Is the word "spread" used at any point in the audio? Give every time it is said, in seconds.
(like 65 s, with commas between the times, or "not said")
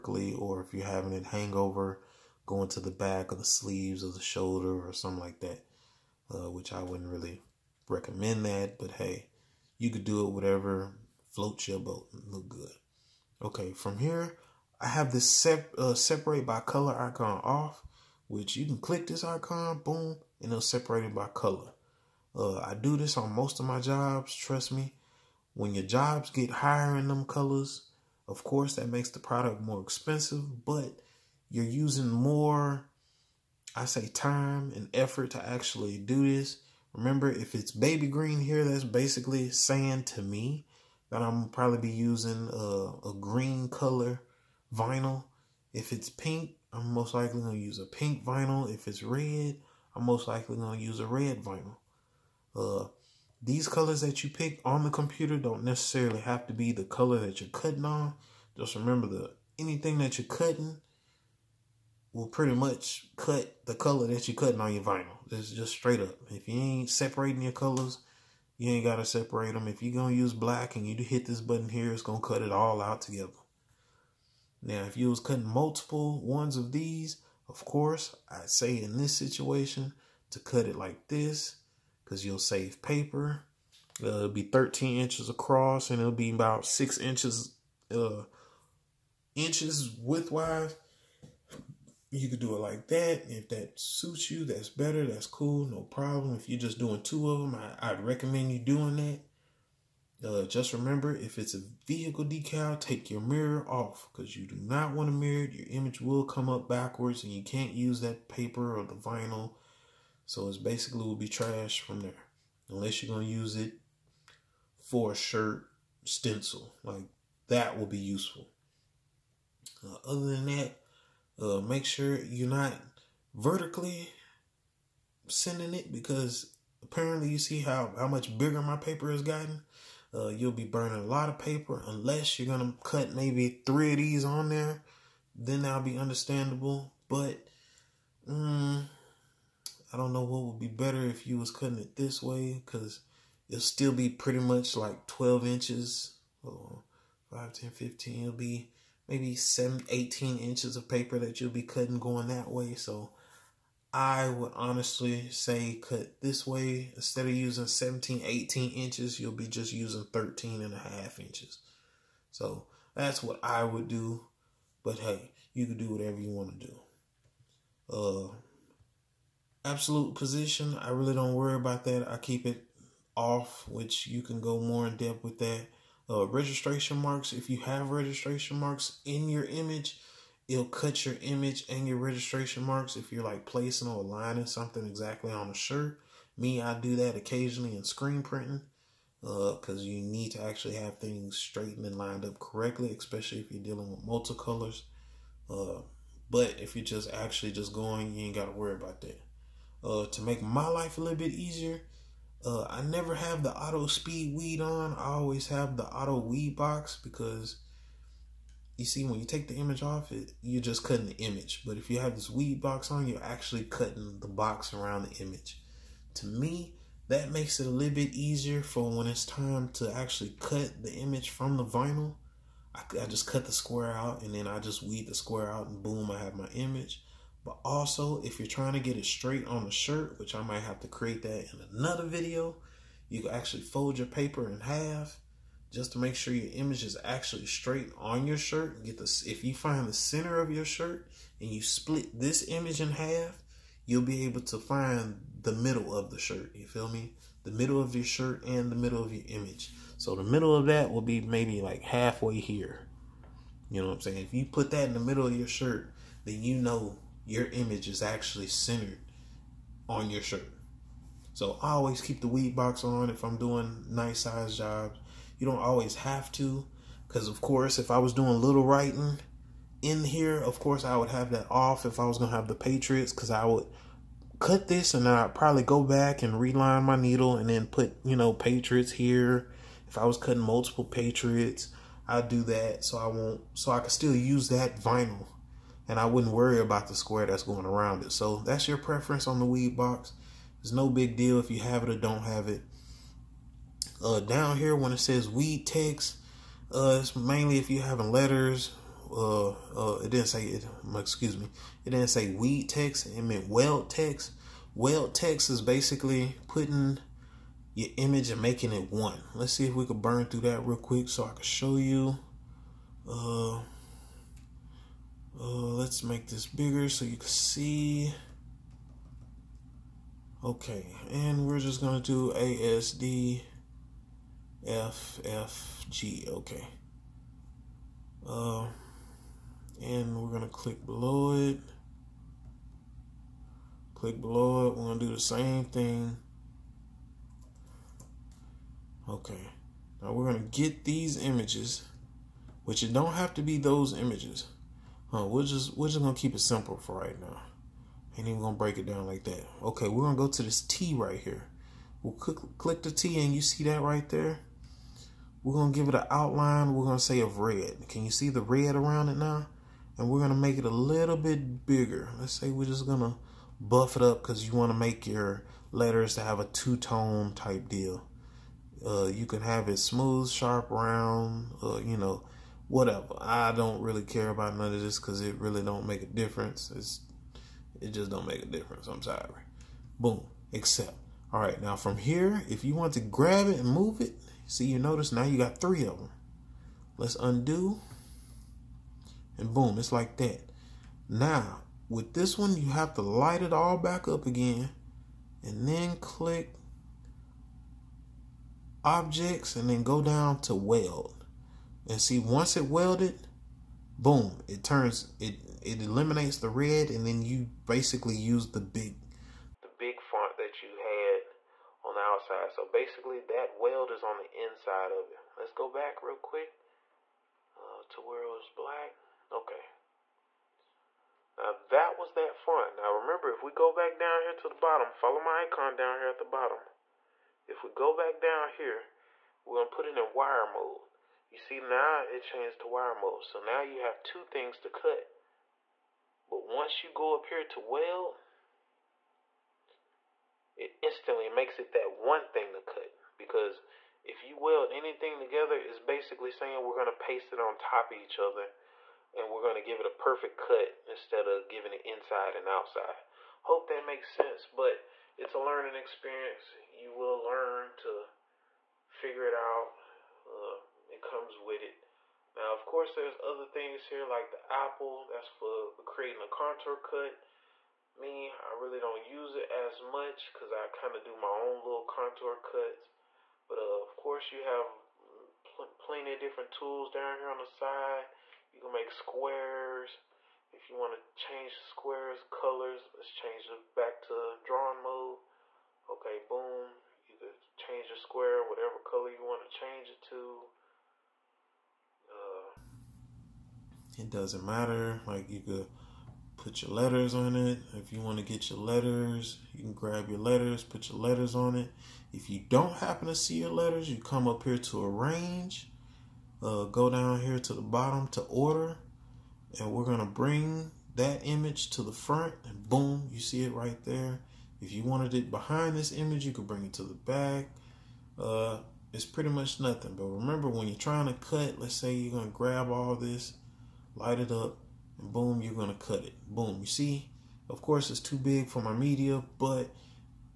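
not said.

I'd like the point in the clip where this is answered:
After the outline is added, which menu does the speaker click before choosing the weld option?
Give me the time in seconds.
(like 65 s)
395 s.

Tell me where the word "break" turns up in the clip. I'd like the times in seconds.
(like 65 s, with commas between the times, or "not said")
348 s.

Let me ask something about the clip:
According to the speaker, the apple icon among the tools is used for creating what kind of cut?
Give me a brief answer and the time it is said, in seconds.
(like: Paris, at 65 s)
Contour cut, at 466 s.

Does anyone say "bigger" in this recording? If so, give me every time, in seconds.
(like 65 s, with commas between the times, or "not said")
128 s, 316 s, 361 s.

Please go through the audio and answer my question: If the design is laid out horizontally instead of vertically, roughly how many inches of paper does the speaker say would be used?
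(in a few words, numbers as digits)
13 and a half inches.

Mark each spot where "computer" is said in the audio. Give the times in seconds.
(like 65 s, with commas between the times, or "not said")
54 s.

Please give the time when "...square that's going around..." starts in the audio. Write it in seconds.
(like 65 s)
286 s.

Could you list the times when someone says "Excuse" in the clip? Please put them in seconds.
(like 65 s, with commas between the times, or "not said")
300 s.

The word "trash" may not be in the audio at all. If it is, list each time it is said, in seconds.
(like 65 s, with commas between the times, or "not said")
111 s.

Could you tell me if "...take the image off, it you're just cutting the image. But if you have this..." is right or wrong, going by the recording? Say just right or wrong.
right.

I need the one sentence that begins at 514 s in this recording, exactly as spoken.
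If you wanted it behind this image, you could bring it to the back.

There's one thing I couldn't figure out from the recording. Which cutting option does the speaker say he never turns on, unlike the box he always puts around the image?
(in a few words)
Auto speed weed.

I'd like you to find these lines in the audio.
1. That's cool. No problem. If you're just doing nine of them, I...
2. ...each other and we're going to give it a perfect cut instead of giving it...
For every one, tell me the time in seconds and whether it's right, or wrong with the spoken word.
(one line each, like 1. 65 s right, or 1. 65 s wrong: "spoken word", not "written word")
1. 95 s wrong: "two", not "nine"
2. 447 s right.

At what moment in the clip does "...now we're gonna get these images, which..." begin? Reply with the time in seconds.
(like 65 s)
340 s.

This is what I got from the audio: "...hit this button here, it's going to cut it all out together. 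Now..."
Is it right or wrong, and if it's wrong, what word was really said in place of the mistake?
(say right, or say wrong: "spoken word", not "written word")
right.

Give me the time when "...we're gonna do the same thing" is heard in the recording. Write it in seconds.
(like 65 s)
334 s.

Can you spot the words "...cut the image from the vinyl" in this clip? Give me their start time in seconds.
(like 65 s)
220 s.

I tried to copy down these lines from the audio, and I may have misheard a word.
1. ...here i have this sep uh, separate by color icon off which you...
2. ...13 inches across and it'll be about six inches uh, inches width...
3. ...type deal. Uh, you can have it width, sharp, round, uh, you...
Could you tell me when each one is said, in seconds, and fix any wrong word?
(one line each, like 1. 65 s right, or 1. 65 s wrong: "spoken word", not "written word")
1. 13 s right
2. 84 s right
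3. 367 s wrong: "smooth", not "width".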